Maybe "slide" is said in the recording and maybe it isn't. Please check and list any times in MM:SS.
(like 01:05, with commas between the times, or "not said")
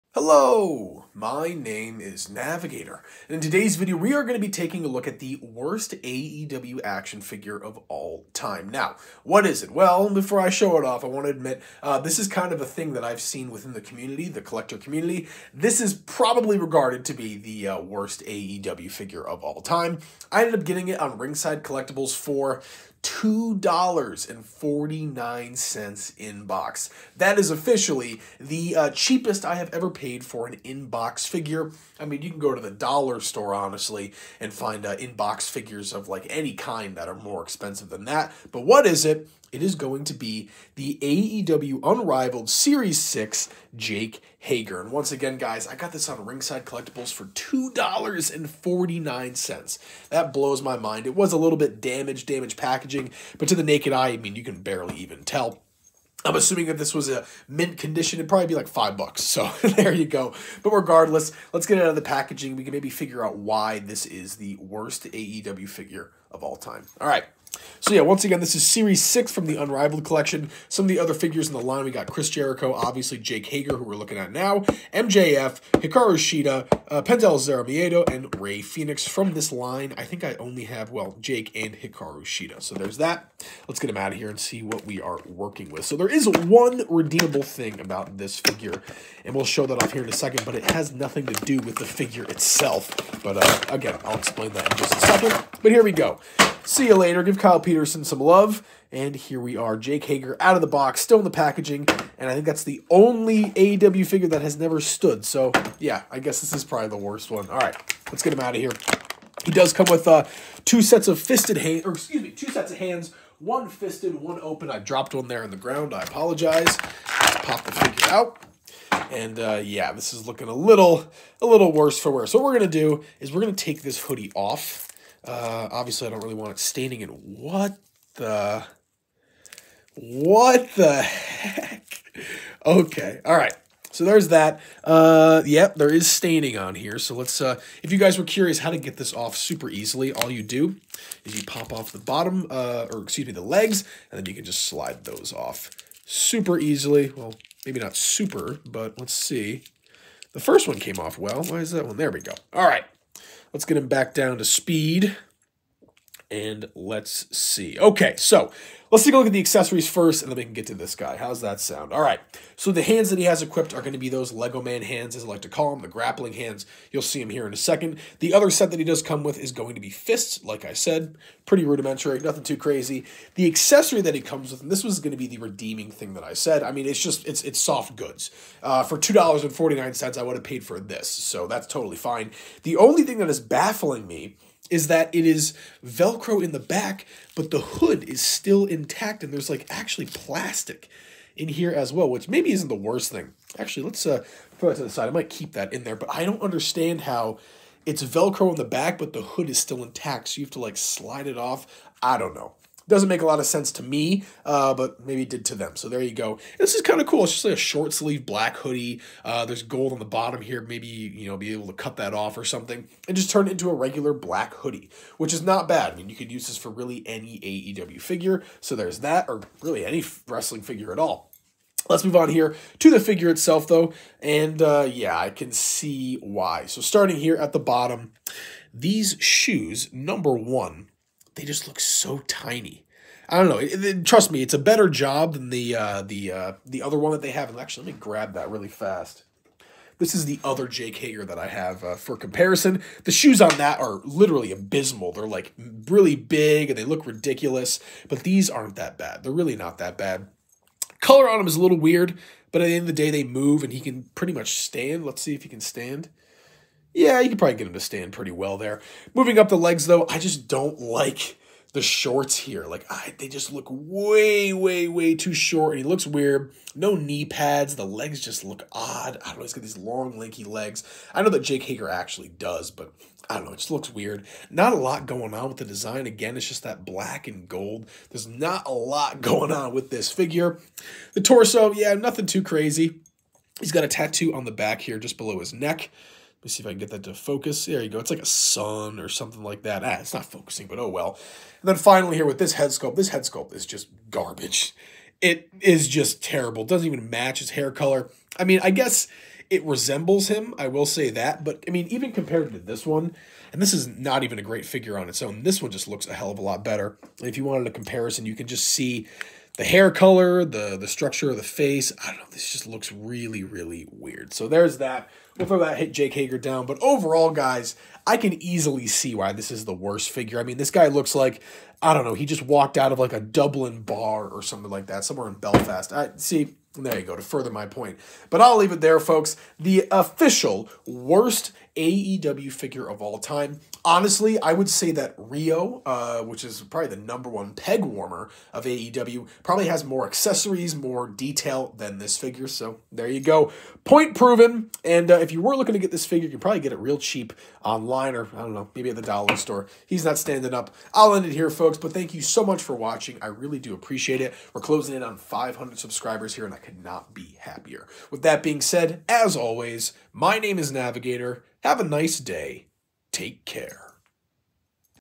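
02:24, 03:20.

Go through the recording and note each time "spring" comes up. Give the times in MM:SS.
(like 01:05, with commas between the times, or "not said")
not said.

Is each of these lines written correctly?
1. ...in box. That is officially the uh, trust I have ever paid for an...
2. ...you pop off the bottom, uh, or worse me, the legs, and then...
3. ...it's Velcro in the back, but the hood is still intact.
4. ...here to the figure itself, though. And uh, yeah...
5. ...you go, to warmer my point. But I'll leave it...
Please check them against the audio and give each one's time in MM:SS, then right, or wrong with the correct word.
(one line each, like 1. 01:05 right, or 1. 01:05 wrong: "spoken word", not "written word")
1. 00:26 wrong: "cheapest", not "trust"
2. 02:21 wrong: "excuse", not "worse"
3. 03:17 right
4. 03:42 right
5. 05:26 wrong: "further", not "warmer".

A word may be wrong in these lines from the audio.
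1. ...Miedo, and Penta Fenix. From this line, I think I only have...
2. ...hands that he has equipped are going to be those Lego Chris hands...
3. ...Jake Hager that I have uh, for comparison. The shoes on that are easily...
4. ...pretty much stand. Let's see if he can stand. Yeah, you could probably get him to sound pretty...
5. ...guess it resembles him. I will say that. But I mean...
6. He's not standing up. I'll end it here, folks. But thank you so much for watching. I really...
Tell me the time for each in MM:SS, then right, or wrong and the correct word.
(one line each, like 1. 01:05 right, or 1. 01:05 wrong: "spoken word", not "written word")
1. 01:17 wrong: "Rey", not "Penta"
2. 02:42 wrong: "Man", not "Chris"
3. 04:00 wrong: "literally", not "easily"
4. 04:14 wrong: "stand", not "sound"
5. 04:58 right
6. 05:49 right.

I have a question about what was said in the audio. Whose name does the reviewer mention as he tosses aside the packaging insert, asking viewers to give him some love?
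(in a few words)
Kyle Peterson.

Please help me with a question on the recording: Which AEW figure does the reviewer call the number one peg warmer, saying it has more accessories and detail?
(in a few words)
Riho.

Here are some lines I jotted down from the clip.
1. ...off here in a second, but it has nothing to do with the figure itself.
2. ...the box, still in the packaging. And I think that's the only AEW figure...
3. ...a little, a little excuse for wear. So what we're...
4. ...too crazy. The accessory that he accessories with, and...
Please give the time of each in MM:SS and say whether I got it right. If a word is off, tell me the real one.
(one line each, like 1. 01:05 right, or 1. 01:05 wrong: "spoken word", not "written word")
1. 01:29 right
2. 01:40 right
3. 02:00 wrong: "worse", not "excuse"
4. 02:52 wrong: "comes", not "accessories".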